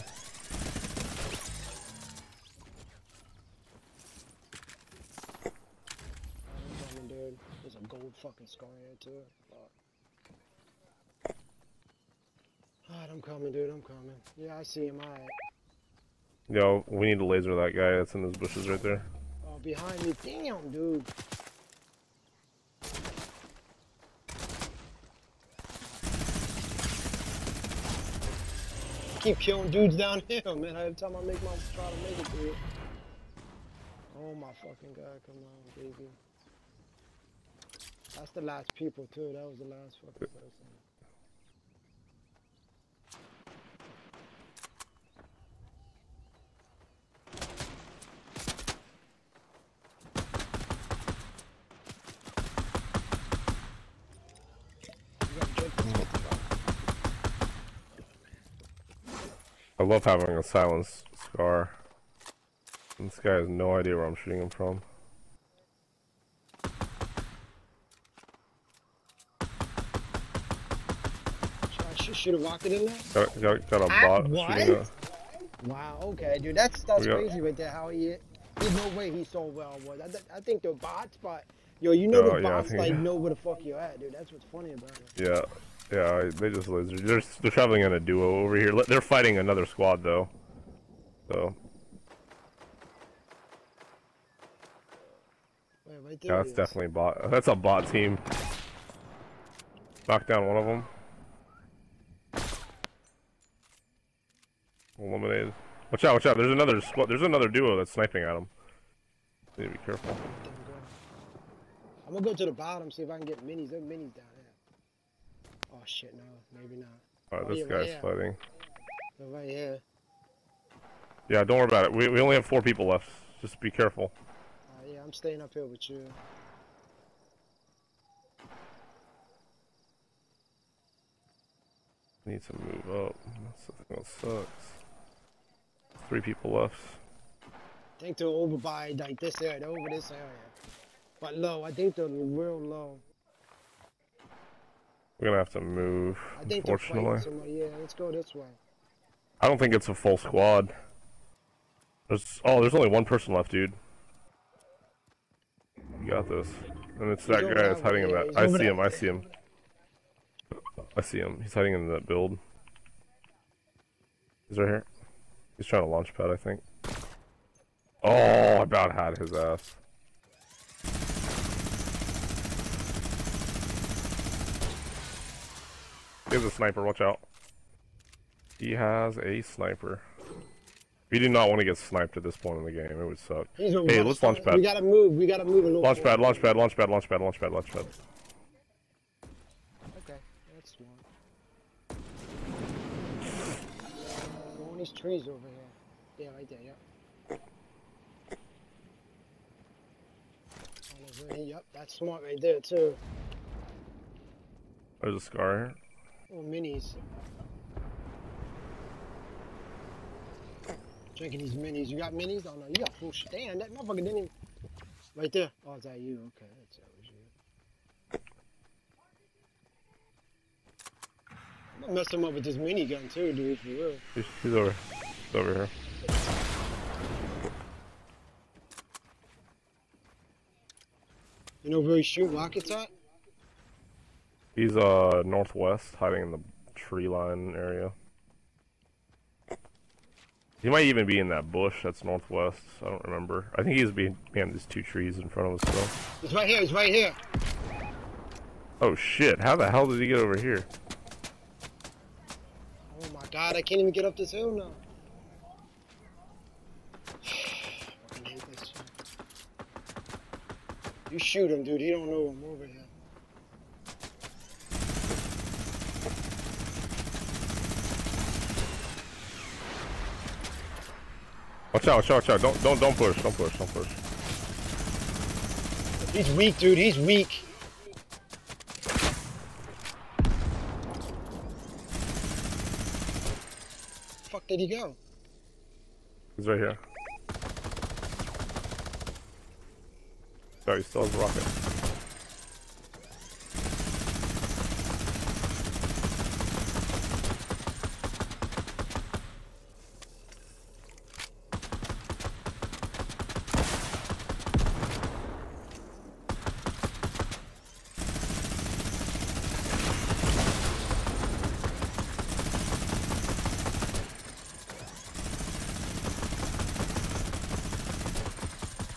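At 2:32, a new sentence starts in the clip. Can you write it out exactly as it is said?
There's oh, there's only one person left, dude.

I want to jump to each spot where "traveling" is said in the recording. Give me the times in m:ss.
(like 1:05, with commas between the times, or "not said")
1:27.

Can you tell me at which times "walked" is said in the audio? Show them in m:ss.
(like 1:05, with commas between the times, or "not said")
1:12.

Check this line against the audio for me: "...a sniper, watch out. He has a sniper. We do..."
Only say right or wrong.
right.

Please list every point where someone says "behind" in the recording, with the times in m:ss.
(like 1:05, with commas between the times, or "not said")
0:19, 4:03.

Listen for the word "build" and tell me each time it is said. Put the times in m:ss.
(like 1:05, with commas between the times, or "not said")
2:42.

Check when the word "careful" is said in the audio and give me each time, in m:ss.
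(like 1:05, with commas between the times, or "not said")
1:49, 2:03.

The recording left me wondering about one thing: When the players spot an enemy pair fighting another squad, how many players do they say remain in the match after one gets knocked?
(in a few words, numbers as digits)
4.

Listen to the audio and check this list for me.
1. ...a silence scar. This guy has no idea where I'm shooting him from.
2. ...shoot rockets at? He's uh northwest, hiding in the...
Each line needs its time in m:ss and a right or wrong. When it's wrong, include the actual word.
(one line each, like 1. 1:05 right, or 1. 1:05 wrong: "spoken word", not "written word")
1. 1:00 right
2. 3:52 right.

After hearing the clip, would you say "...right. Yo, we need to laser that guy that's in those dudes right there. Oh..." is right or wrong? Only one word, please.
wrong.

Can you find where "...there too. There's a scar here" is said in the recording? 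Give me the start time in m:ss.
3:22.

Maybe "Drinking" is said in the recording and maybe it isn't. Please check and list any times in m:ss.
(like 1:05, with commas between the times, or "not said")
3:31.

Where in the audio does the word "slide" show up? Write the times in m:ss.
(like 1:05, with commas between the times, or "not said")
not said.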